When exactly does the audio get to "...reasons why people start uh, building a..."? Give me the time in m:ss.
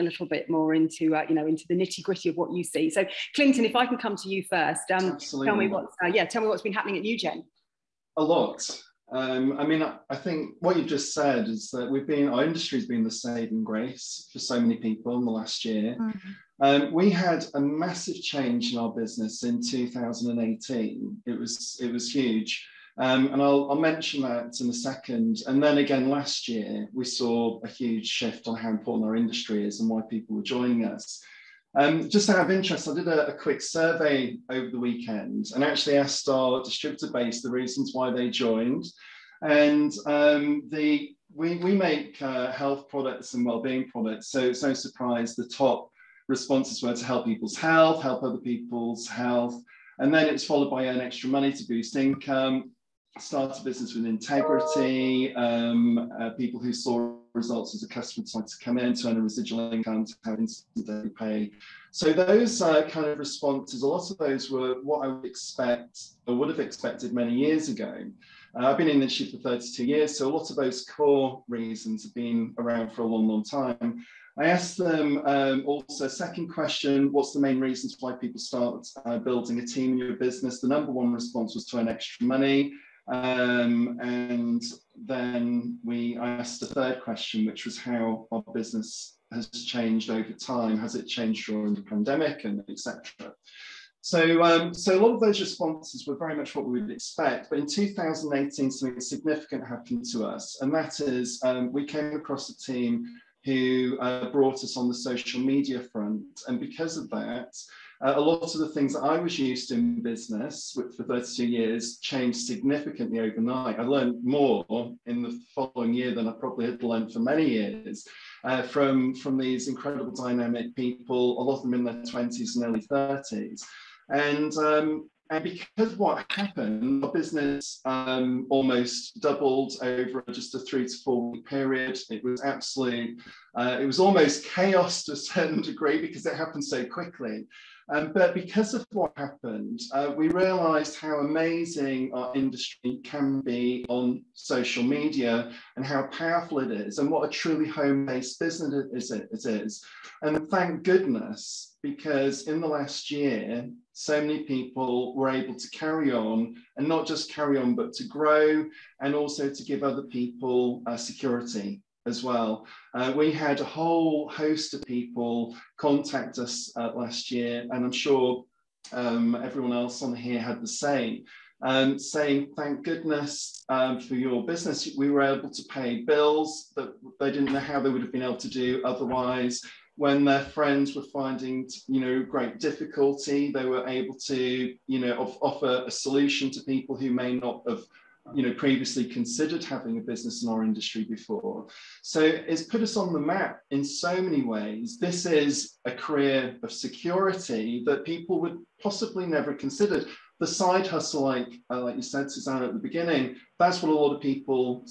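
1:17.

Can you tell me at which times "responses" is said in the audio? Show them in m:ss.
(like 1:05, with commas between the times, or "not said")
0:46, 1:03, 1:21, 1:35.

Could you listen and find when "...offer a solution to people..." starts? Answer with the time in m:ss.
3:05.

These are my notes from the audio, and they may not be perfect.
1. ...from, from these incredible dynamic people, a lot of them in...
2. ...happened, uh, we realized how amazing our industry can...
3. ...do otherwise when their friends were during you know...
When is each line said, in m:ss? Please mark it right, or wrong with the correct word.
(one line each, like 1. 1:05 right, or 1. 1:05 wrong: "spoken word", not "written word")
1. 1:58 right
2. 2:19 right
3. 2:58 wrong: "finding", not "during".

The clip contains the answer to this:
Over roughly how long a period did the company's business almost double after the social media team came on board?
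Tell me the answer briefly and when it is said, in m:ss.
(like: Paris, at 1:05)
3 to 4 weeks, at 2:10.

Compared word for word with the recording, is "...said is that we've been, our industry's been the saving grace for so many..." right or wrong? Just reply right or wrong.
right.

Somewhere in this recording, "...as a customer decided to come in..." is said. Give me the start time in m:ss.
0:57.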